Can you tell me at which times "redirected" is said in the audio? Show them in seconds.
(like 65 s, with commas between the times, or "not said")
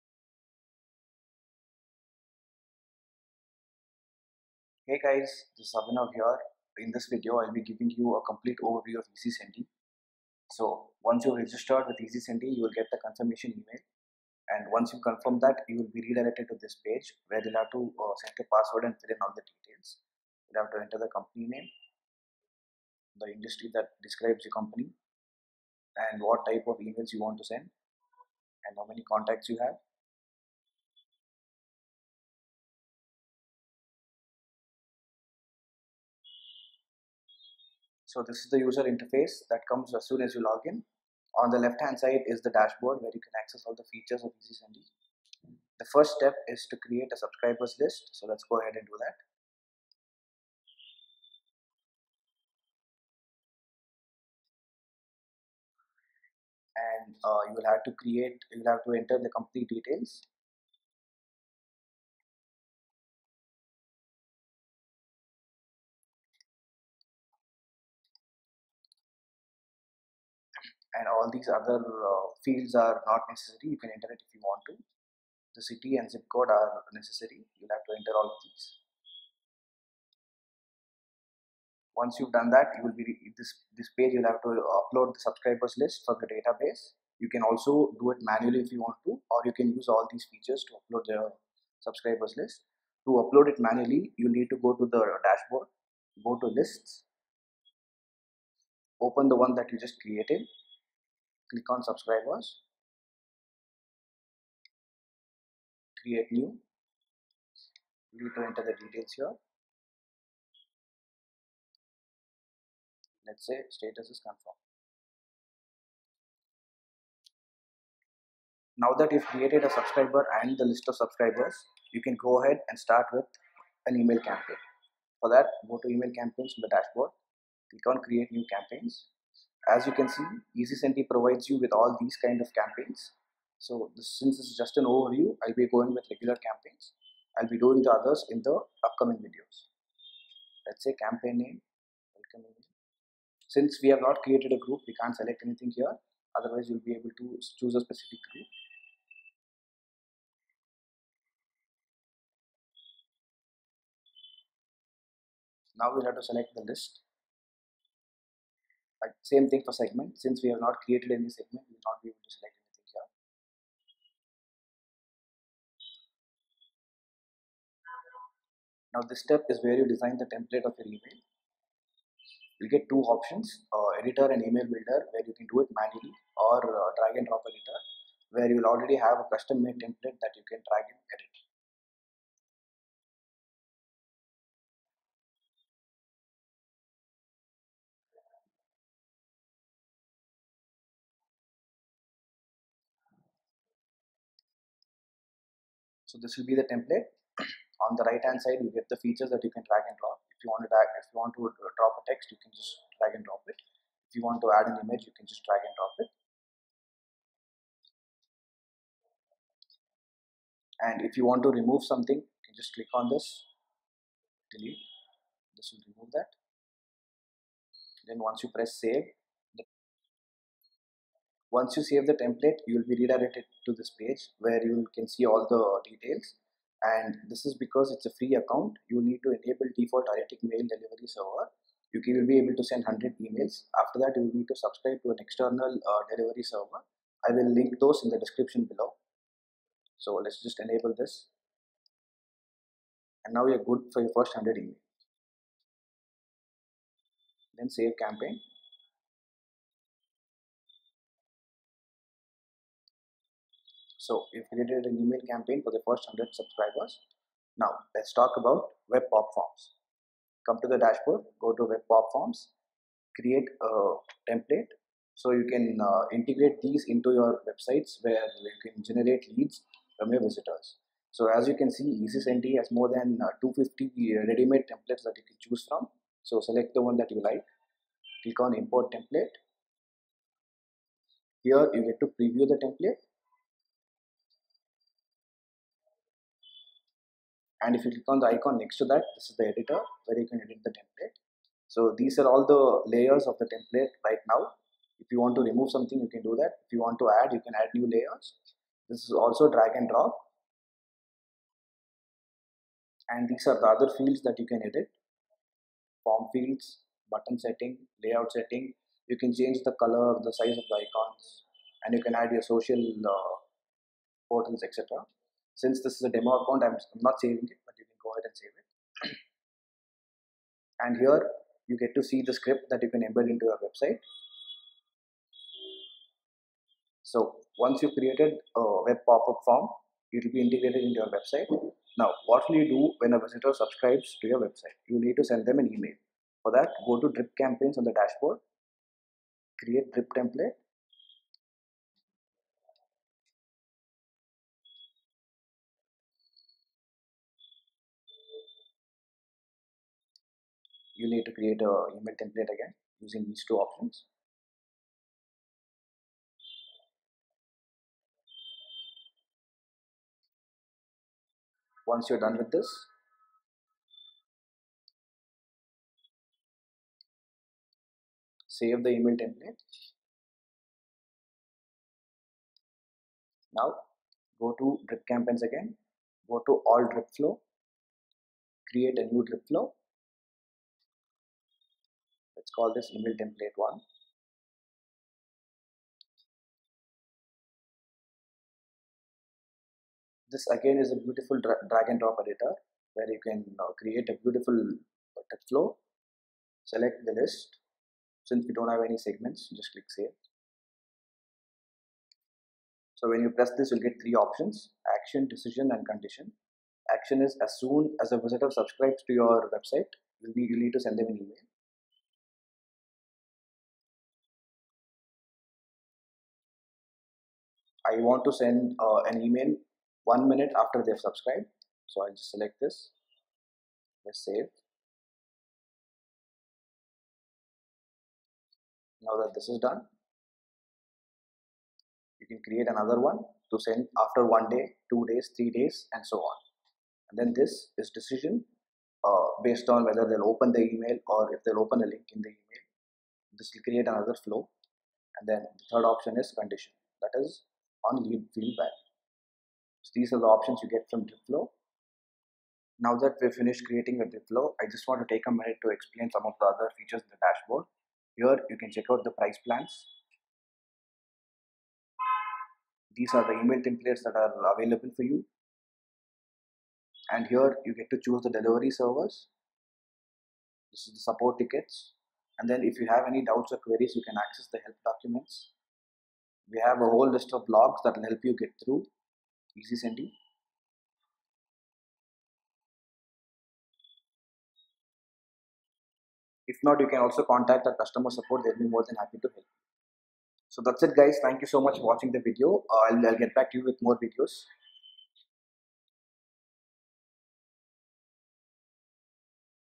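16 s, 223 s.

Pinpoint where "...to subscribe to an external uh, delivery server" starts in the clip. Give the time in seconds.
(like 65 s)
234 s.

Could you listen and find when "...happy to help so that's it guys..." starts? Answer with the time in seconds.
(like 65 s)
488 s.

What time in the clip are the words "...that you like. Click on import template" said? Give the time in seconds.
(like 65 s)
276 s.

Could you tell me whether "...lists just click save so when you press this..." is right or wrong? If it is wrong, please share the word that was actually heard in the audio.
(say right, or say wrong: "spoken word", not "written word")
wrong: "segments", not "lists".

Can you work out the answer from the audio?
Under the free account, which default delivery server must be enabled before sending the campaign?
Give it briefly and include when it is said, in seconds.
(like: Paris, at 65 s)
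AriticMail, at 230 s.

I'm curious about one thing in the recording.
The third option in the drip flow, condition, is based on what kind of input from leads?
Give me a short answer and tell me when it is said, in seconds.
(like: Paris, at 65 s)
lead feedback, at 448 s.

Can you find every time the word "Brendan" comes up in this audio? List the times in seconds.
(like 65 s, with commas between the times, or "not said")
not said.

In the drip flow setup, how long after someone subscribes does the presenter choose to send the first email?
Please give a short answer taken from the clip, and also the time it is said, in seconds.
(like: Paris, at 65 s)
one minute, at 420 s.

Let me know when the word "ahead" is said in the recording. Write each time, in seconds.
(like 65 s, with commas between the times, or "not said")
48 s, 122 s, 318 s.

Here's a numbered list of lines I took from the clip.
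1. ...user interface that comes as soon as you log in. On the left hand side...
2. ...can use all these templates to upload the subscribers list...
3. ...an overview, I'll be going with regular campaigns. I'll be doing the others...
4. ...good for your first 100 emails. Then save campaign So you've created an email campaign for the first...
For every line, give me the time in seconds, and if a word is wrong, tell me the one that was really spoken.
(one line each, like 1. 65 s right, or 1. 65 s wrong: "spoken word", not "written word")
1. 38 s right
2. 89 s wrong: "features", not "templates"
3. 134 s right
4. 243 s right.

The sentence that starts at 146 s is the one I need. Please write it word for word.
Otherwise, you'll be able to choose a specific group.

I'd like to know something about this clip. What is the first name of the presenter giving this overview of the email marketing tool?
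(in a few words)
Abhinav.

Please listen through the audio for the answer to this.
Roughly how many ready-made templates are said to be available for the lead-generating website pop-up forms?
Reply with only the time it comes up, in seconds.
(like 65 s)
272 s.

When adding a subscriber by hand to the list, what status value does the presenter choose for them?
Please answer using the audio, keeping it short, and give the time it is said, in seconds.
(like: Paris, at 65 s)
confirmed, at 114 s.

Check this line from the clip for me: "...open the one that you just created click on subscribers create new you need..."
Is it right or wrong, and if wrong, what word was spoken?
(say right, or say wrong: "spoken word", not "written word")
right.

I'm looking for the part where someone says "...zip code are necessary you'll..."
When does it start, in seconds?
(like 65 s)
76 s.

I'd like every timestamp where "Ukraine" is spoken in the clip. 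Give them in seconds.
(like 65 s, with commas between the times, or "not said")
not said.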